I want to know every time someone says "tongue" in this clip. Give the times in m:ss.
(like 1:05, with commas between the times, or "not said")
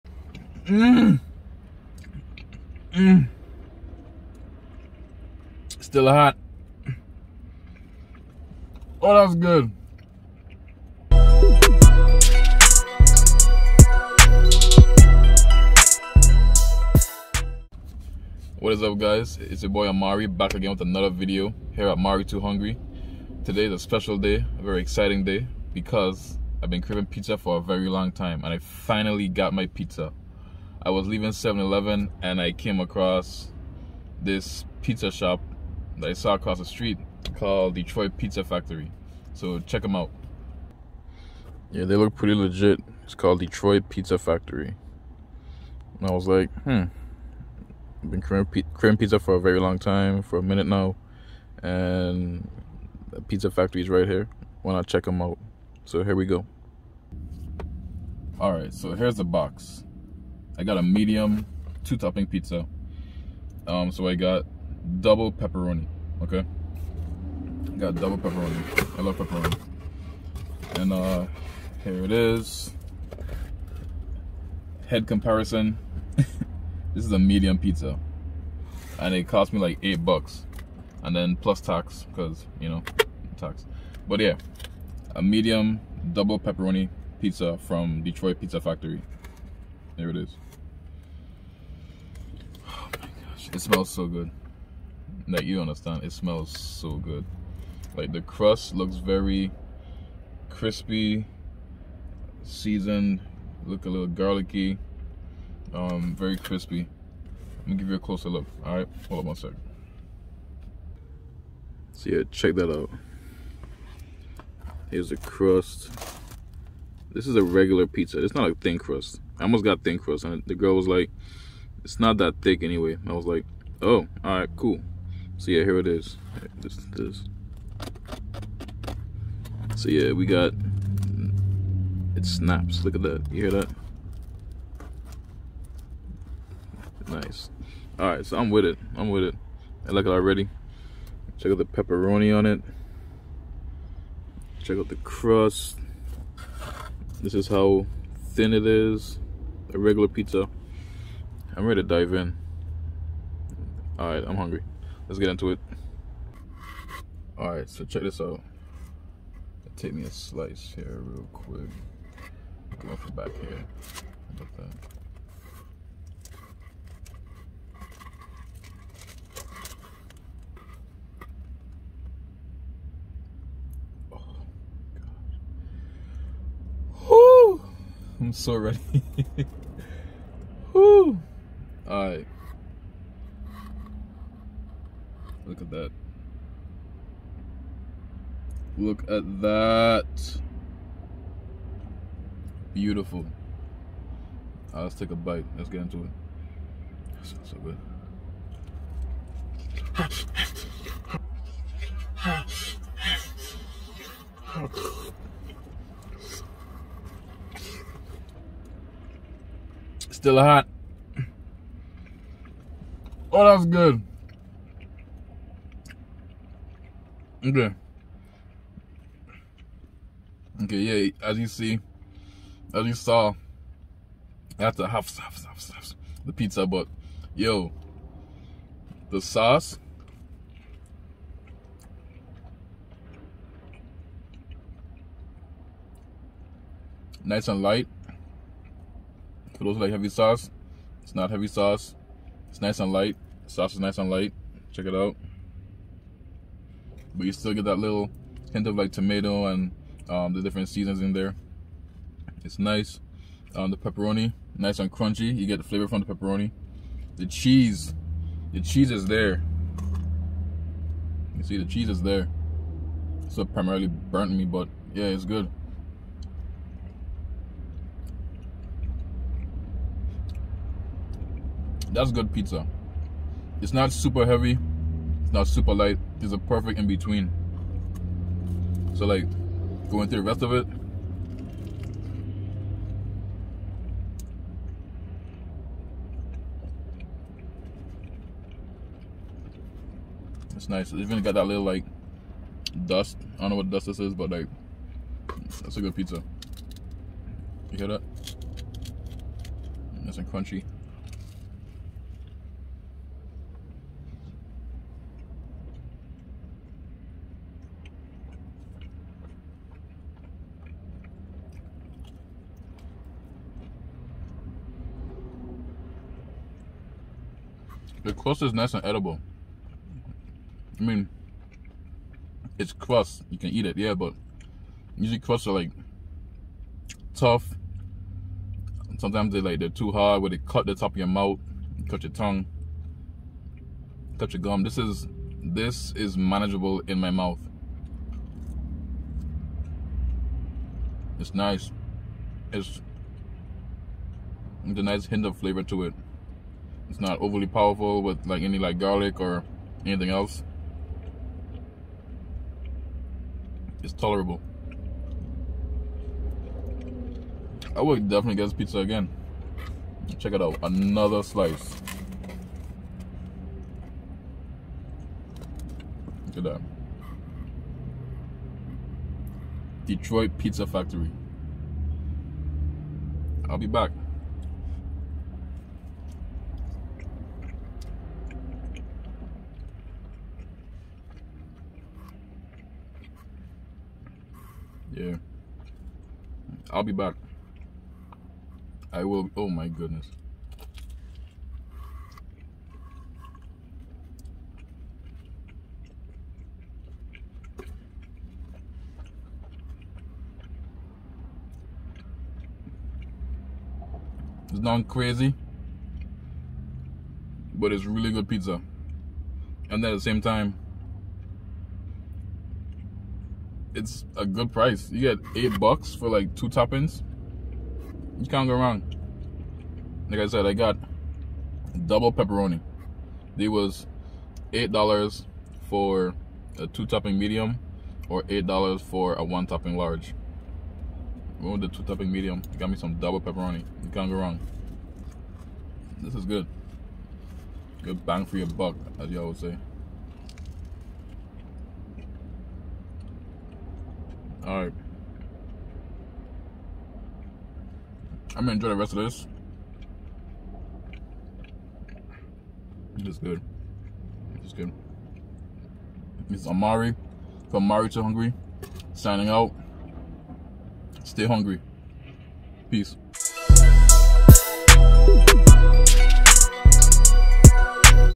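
5:32.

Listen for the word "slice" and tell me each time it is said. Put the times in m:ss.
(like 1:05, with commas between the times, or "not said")
2:40, 6:01.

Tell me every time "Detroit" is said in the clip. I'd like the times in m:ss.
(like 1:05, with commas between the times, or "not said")
0:37, 0:43, 1:28, 6:09.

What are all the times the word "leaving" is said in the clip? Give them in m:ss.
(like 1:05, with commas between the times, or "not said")
0:31.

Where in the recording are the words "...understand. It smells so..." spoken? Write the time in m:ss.
1:35.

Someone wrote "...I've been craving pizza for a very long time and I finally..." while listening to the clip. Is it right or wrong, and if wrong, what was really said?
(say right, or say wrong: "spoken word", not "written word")
right.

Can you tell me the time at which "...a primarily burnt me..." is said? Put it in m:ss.
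4:23.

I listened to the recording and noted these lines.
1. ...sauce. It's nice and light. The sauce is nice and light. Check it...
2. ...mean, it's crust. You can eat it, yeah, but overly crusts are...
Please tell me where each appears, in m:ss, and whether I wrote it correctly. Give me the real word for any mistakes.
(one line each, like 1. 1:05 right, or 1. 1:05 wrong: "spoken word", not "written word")
1. 4:01 right
2. 5:20 wrong: "usually", not "overly".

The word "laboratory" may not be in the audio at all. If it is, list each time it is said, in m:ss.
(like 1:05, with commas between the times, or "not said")
not said.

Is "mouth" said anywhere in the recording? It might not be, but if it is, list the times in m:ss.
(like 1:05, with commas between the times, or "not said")
5:31, 5:37.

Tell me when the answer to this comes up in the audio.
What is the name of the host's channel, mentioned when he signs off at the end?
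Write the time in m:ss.
7:37.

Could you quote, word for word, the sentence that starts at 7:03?
They was eight dollars for a two topping medium or eight dollars for a one topping large.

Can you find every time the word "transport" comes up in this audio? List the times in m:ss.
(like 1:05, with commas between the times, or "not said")
not said.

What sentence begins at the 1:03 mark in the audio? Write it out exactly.
Um, so I got double pepperoni.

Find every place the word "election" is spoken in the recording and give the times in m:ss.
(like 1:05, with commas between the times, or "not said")
not said.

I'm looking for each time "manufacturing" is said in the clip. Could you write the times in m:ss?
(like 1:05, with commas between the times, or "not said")
not said.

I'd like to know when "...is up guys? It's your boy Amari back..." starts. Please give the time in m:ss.
0:18.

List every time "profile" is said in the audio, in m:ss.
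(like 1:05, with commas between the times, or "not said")
not said.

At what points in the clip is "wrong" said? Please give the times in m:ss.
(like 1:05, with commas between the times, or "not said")
6:58, 7:14.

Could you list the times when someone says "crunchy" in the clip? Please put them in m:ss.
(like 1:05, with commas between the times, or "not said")
4:14, 5:00.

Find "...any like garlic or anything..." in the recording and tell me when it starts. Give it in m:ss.
5:48.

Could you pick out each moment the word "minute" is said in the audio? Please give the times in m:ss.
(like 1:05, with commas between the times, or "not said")
0:50.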